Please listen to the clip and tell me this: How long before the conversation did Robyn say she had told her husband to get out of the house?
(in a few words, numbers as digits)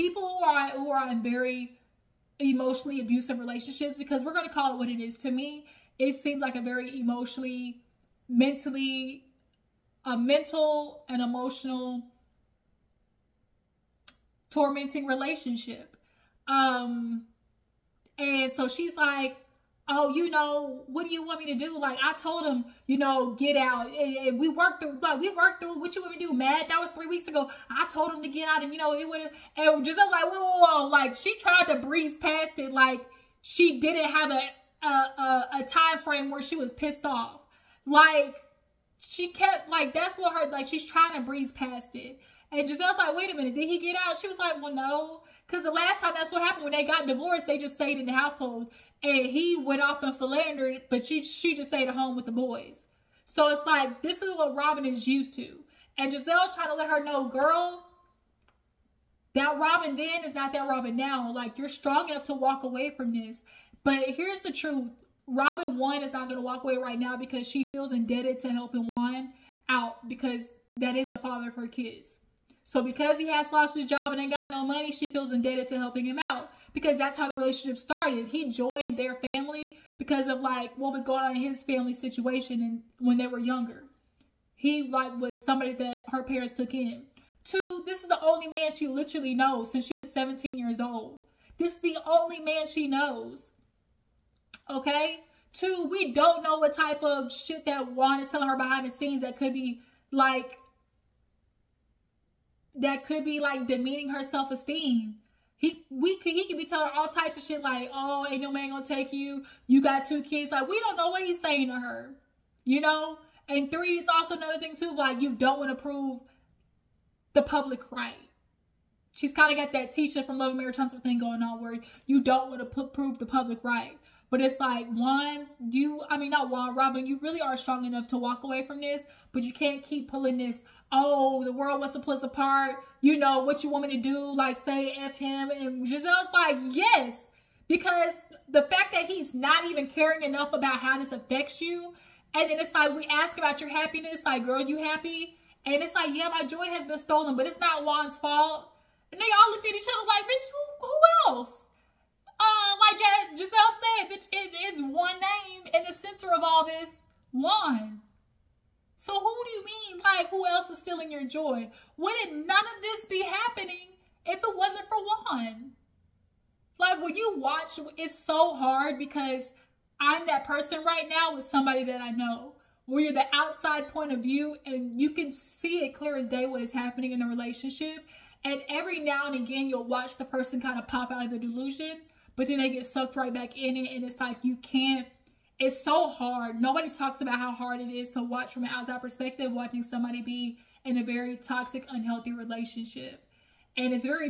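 3 weeks.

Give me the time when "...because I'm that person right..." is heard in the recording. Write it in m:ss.
2:48.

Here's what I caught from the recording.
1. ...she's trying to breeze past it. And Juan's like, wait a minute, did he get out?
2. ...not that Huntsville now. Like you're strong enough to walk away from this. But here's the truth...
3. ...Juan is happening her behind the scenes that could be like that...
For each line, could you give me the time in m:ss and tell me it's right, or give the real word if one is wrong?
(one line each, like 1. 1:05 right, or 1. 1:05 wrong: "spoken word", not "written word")
1. 0:40 wrong: "Gizelle", not "Juan"
2. 1:00 wrong: "Robyn", not "Huntsville"
3. 1:37 wrong: "telling", not "happening".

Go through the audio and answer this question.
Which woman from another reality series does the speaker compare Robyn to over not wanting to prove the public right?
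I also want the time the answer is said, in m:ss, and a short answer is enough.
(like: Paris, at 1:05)
Tisha, at 1:59.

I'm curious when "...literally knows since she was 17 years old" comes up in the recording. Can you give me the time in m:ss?
1:28.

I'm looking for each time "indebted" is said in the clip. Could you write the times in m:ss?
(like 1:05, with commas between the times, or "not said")
1:07, 1:15.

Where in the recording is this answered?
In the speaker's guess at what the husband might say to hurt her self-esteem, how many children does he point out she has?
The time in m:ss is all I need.
1:50.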